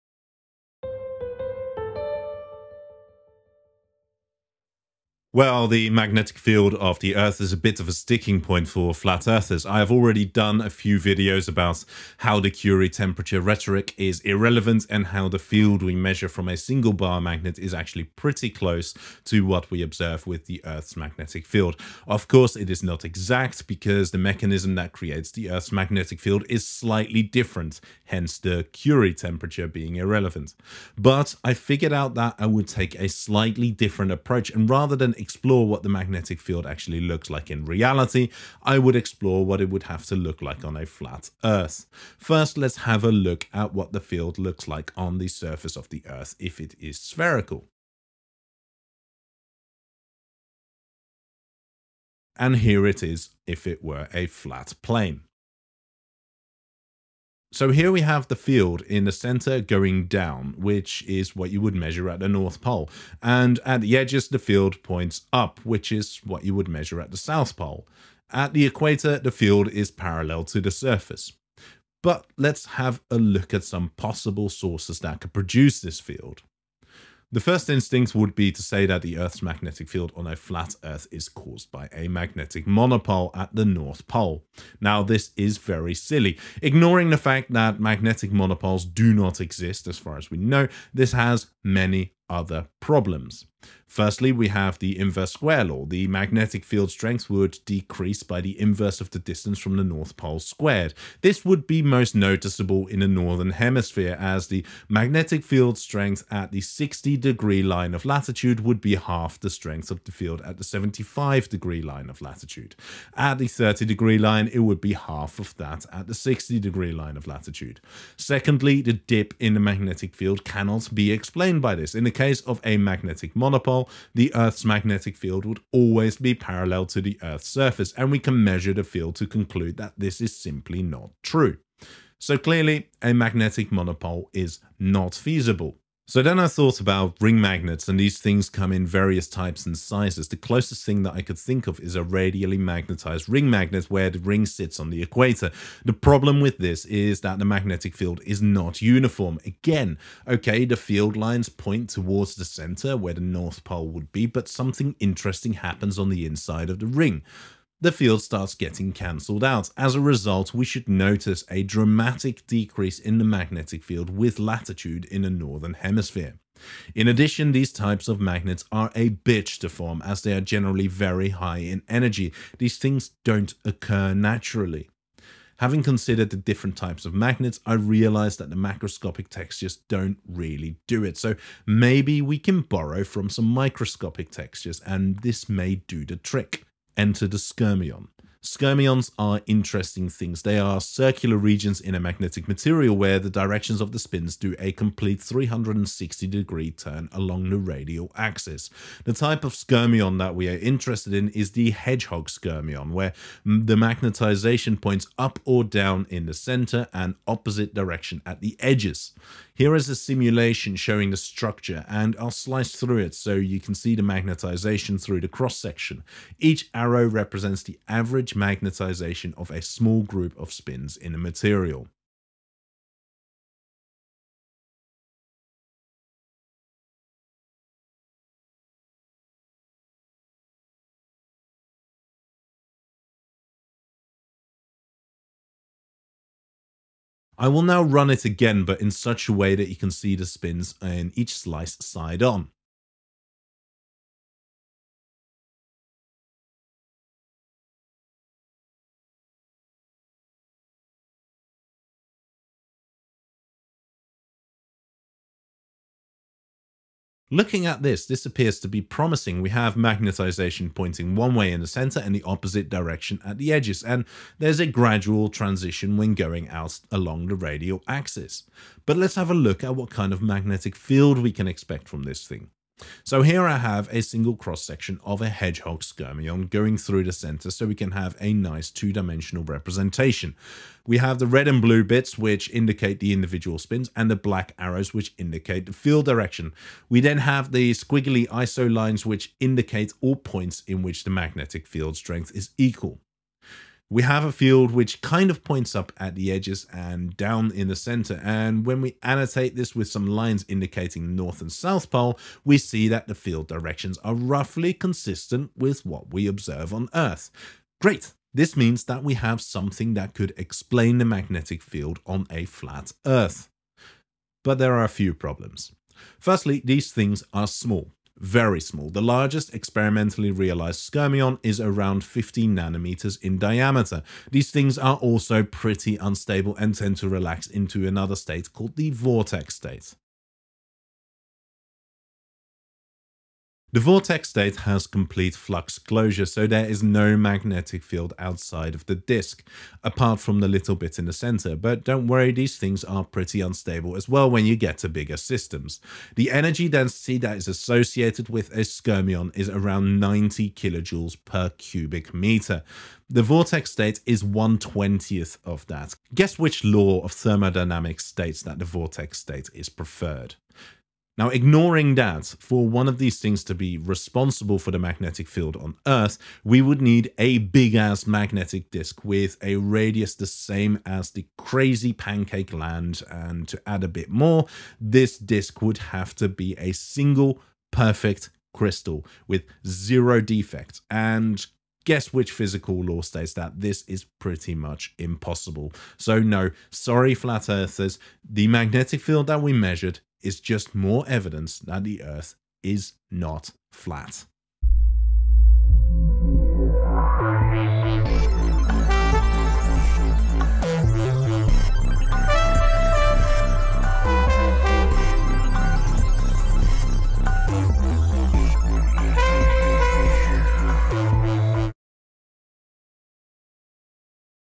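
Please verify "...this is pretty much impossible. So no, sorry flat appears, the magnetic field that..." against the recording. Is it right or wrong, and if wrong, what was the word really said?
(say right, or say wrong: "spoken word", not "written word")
wrong: "earthers", not "appears".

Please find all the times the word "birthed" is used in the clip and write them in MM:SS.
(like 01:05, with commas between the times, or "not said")
not said.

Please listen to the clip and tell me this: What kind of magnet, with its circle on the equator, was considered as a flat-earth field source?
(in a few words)
radially magnetized ring magnet.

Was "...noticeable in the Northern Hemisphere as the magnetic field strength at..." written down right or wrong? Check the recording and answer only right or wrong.
right.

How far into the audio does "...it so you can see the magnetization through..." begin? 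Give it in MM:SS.
03:32.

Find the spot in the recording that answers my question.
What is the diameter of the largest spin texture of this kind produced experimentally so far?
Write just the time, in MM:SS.
05:22.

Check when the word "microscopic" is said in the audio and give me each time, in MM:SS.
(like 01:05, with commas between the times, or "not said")
03:03.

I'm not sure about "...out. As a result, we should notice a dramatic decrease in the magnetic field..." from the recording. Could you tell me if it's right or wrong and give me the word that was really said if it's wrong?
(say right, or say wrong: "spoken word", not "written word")
right.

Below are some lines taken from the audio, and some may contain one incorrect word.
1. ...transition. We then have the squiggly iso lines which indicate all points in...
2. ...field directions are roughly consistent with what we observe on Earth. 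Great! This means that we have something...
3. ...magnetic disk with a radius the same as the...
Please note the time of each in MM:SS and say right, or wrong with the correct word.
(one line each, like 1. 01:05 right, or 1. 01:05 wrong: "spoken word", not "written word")
1. 04:46 wrong: "direction", not "transition"
2. 05:03 right
3. 06:08 right.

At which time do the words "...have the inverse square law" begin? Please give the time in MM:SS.
01:34.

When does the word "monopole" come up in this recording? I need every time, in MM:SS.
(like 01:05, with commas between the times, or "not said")
01:22, 01:28, 02:03, 02:13.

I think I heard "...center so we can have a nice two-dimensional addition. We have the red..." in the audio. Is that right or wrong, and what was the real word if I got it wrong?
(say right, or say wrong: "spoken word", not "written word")
wrong: "representation", not "addition".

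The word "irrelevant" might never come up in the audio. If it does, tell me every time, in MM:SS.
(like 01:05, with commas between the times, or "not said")
00:14, 00:29.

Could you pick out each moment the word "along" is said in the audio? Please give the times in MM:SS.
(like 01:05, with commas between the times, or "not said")
03:17, 04:26.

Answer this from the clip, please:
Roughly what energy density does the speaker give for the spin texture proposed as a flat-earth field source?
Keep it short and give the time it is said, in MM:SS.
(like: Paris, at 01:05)
90 kJ per cubic meter, at 05:50.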